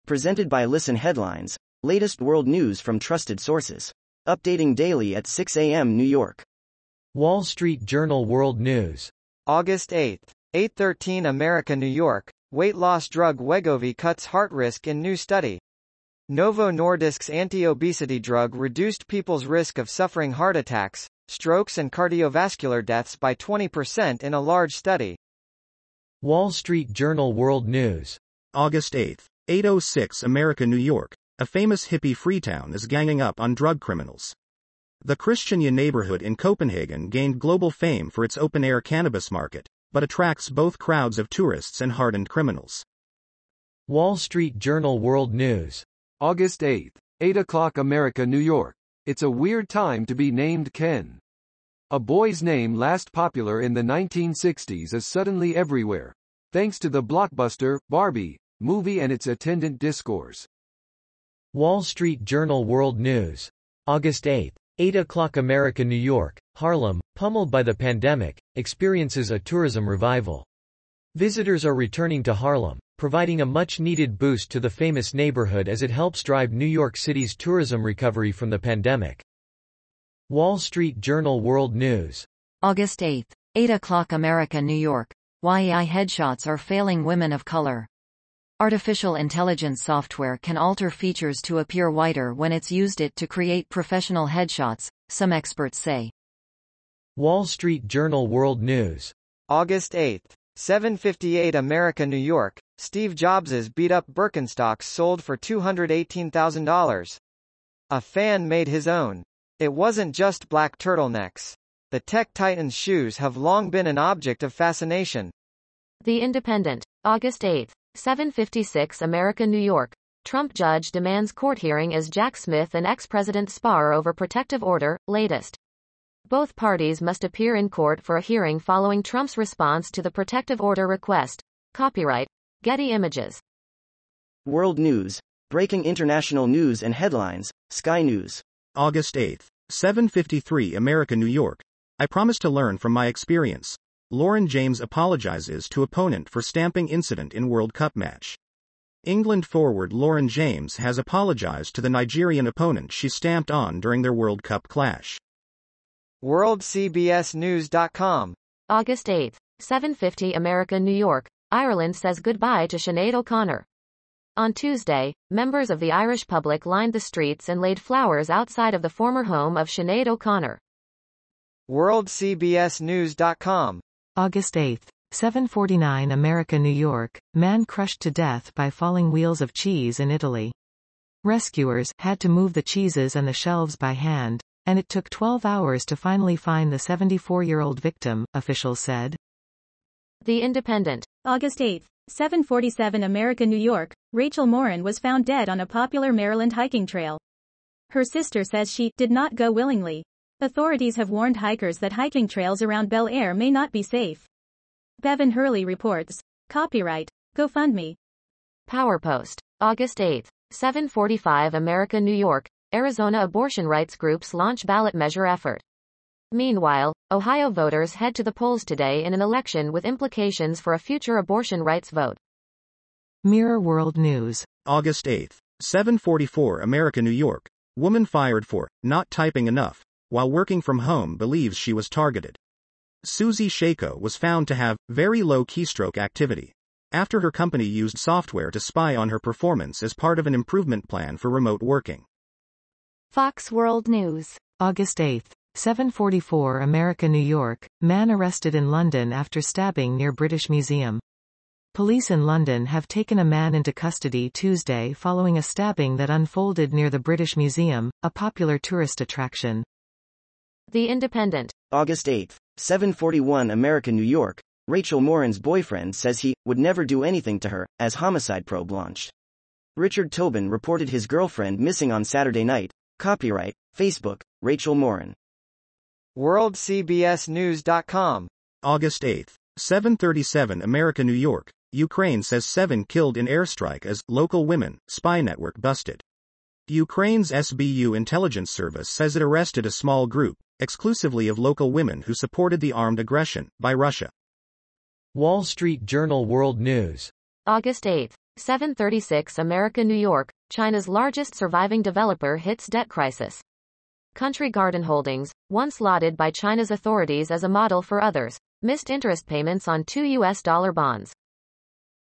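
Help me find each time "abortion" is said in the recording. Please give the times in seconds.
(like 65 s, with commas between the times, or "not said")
213 s, 221 s.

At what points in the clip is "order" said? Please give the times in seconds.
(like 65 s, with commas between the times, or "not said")
124 s, 130 s.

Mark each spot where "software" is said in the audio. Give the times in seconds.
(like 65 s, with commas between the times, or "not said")
89 s, 237 s.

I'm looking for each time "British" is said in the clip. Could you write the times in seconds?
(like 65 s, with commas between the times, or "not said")
250 s, 256 s.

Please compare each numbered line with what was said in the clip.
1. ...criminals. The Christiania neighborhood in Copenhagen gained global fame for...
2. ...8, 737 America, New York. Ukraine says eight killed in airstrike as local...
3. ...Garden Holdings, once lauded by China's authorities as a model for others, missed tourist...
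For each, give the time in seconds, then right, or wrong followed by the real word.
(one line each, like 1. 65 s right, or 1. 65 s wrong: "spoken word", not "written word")
1. 33 s right
2. 279 s wrong: "seven", not "eight"
3. 304 s wrong: "interest", not "tourist".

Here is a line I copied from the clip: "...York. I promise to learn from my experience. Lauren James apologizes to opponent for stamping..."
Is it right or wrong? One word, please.
right.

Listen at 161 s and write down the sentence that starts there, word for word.
Ireland says goodbye to Sinead O'Connor.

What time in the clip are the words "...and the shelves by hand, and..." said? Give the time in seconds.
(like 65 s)
183 s.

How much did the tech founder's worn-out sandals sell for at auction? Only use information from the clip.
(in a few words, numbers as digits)
$218,000.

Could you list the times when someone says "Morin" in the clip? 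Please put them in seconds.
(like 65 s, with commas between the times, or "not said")
194 s, 265 s, 274 s.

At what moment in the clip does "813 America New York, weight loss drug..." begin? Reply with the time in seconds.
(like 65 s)
10 s.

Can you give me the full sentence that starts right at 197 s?
Her sister says she did not go willingly, Authorities have warned hikers that hiking trails around Bel Air may not be safe.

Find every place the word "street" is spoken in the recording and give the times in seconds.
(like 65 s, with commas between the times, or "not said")
7 s, 26 s, 44 s, 61 s, 80 s, 97 s, 166 s, 295 s.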